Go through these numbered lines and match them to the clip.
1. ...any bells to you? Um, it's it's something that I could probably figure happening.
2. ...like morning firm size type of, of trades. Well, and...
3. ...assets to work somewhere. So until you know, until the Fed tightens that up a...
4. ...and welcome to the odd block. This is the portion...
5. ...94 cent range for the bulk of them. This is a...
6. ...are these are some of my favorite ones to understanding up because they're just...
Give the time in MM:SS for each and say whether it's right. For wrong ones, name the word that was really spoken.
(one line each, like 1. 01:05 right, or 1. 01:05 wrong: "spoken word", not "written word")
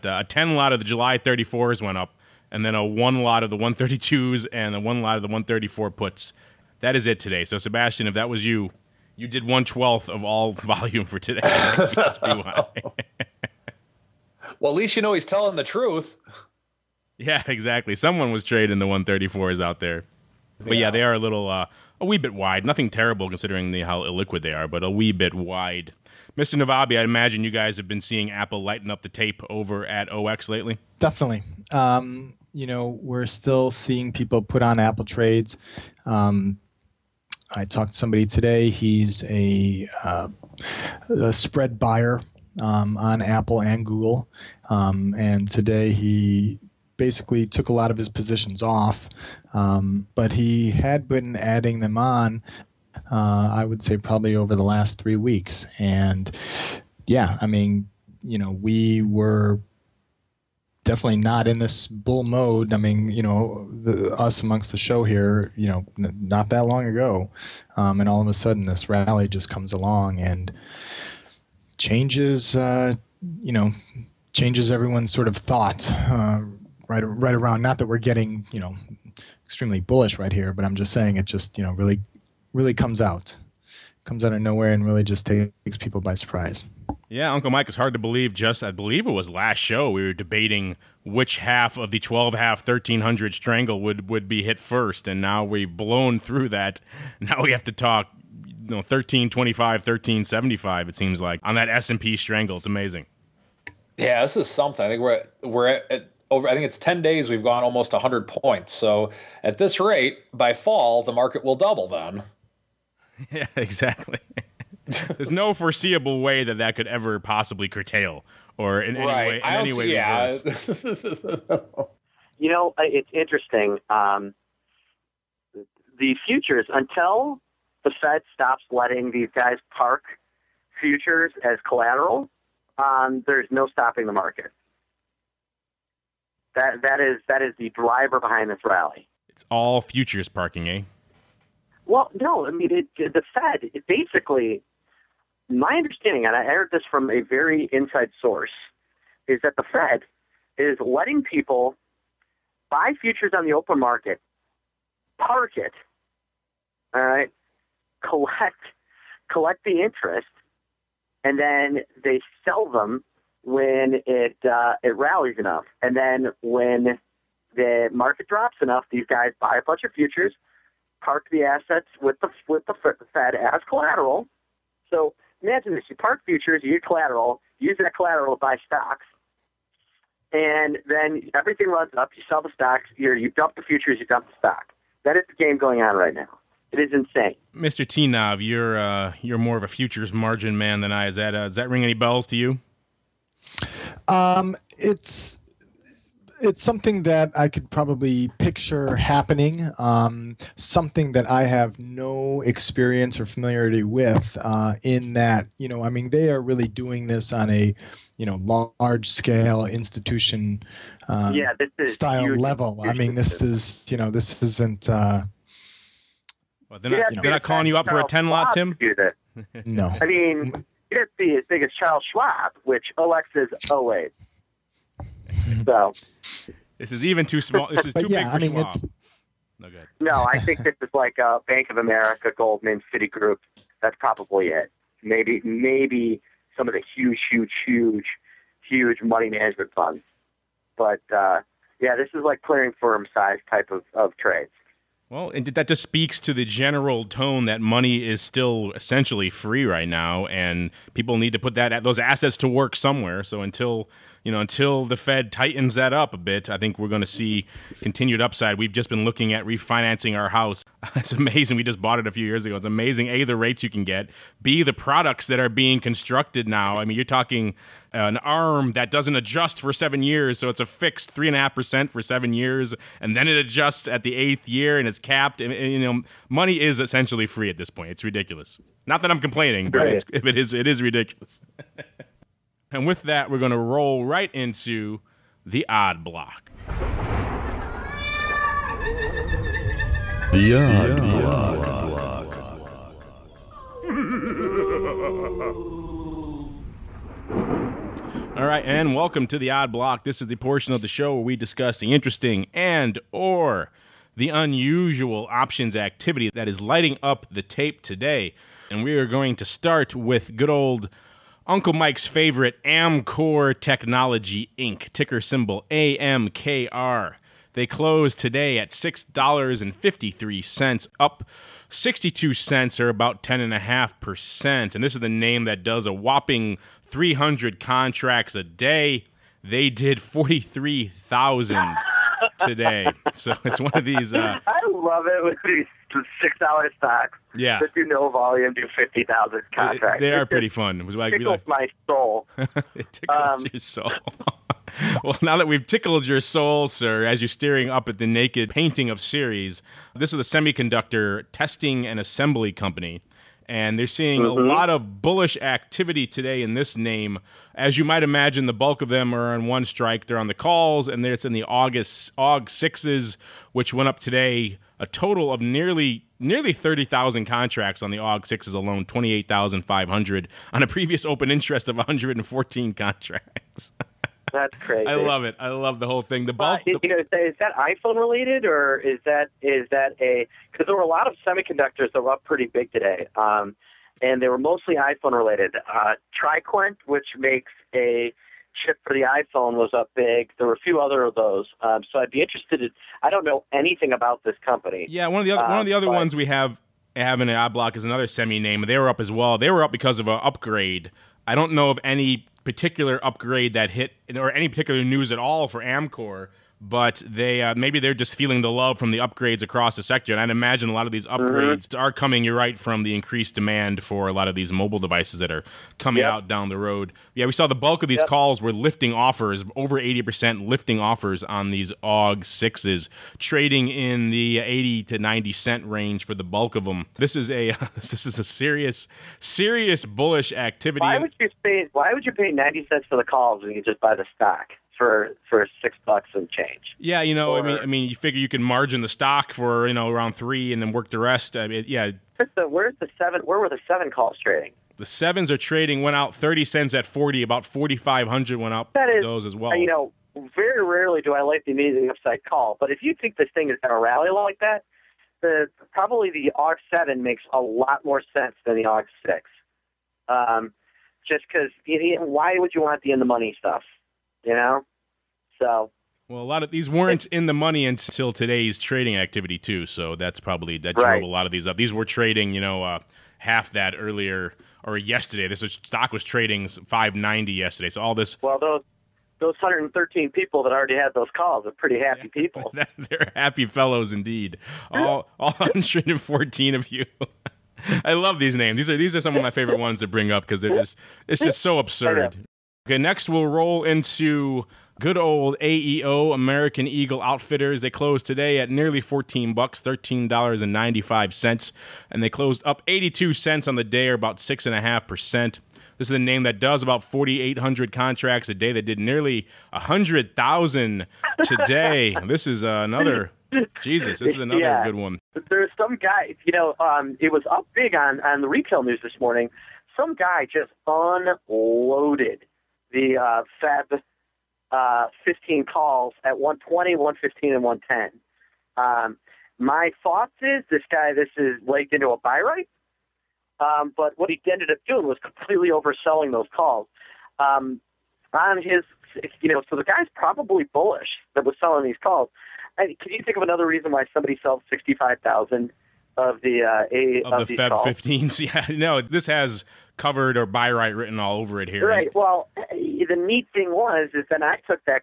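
1. 03:11 wrong: "picture", not "figure"
2. 04:02 wrong: "clearing", not "morning"
3. 04:11 right
4. 04:58 right
5. 07:04 wrong: "90", not "94"
6. 08:08 wrong: "bring", not "understanding".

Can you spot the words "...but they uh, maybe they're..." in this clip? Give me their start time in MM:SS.
06:46.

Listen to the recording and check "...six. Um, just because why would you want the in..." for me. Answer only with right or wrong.
right.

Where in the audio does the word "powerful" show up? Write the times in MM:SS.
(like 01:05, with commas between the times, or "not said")
not said.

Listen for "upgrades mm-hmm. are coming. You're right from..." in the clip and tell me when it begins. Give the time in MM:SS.
06:51.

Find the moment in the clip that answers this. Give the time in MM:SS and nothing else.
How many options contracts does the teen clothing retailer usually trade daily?
08:26.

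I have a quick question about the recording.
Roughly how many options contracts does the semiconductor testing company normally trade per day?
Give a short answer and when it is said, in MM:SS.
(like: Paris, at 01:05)
300, at 05:26.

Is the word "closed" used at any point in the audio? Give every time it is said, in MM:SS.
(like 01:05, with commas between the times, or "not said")
05:17, 08:17, 08:22.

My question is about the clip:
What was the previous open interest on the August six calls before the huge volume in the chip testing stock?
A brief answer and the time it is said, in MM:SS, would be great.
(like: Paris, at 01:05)
114, at 06:11.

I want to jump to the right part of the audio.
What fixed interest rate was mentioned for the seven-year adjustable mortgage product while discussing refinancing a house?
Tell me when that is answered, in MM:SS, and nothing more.
04:31.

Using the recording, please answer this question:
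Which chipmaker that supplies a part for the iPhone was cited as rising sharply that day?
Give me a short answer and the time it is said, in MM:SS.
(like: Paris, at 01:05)
TriQuint, at 06:26.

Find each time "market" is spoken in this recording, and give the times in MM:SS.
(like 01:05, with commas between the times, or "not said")
01:51, 02:14, 02:33, 02:47.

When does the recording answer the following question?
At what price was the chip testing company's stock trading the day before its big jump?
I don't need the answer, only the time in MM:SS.
07:56.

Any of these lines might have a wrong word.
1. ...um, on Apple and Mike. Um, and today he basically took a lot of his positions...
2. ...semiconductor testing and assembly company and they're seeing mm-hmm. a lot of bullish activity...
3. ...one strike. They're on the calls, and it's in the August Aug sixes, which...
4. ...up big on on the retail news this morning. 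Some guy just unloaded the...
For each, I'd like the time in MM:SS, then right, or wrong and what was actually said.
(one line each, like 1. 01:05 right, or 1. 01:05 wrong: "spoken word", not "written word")
1. 00:42 wrong: "Google", not "Mike"
2. 05:50 right
3. 05:59 right
4. 08:37 right.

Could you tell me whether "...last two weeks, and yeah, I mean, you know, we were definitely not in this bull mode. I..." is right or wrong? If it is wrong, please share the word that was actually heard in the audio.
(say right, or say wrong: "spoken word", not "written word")
wrong: "three", not "two".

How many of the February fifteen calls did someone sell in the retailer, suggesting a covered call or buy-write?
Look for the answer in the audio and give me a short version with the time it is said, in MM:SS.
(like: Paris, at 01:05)
65,000, at 09:04.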